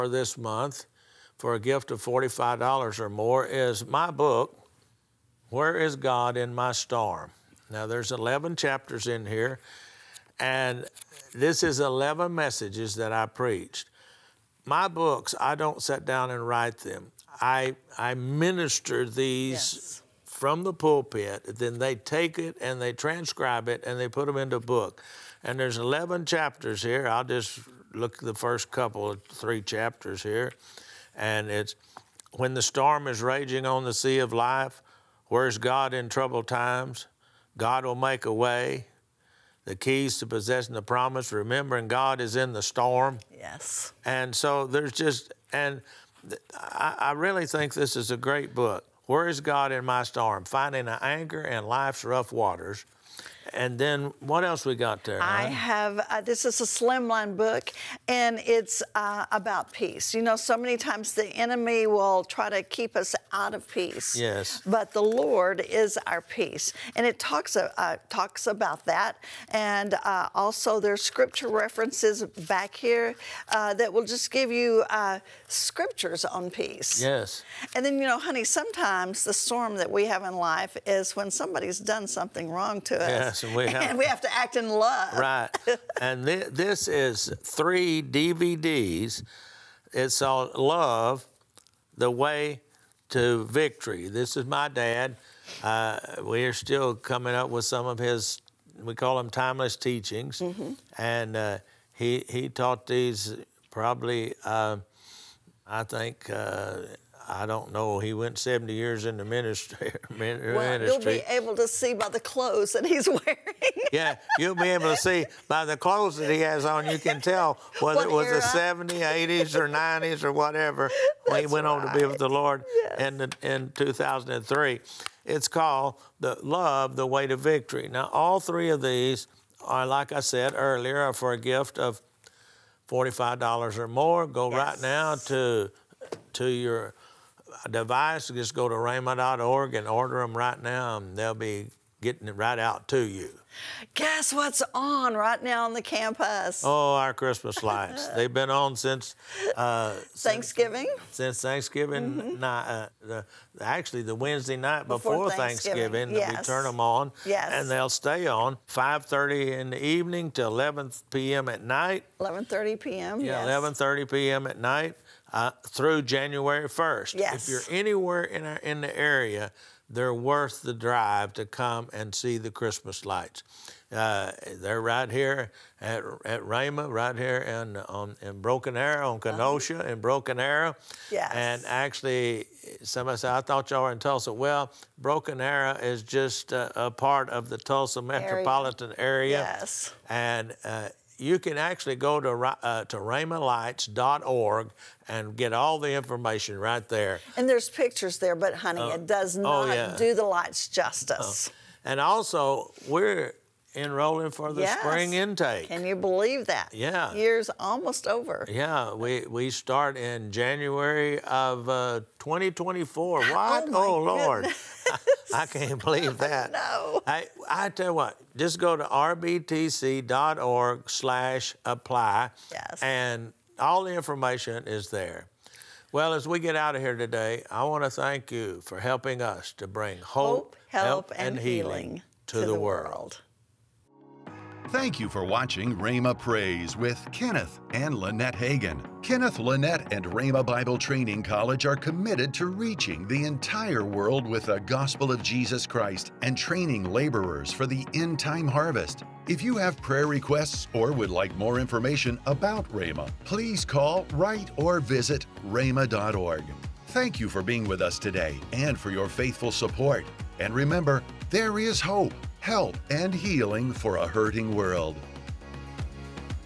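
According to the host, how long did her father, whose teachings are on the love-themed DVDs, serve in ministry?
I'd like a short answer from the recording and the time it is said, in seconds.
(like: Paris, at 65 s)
70 years, at 108 s.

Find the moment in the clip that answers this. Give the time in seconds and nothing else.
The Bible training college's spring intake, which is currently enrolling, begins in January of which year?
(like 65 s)
212 s.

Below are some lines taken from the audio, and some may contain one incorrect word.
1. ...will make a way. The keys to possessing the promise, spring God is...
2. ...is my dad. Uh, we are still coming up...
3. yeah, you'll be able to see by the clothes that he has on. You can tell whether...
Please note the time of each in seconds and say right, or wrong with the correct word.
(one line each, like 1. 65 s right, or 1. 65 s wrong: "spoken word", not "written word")
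1. 37 s wrong: "remembering", not "spring"
2. 94 s right
3. 113 s right.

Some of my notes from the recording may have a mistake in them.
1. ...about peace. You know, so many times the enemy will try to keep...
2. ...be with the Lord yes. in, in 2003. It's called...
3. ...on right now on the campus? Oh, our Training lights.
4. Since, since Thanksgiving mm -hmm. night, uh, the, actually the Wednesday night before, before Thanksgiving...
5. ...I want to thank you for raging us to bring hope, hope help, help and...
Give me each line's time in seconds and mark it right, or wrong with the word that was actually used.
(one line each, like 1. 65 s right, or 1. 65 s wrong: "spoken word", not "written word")
1. 59 s right
2. 121 s right
3. 144 s wrong: "Christmas", not "Training"
4. 150 s right
5. 227 s wrong: "helping", not "raging".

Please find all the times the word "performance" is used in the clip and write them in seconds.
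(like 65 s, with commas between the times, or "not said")
not said.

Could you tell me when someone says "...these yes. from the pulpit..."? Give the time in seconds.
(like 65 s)
19 s.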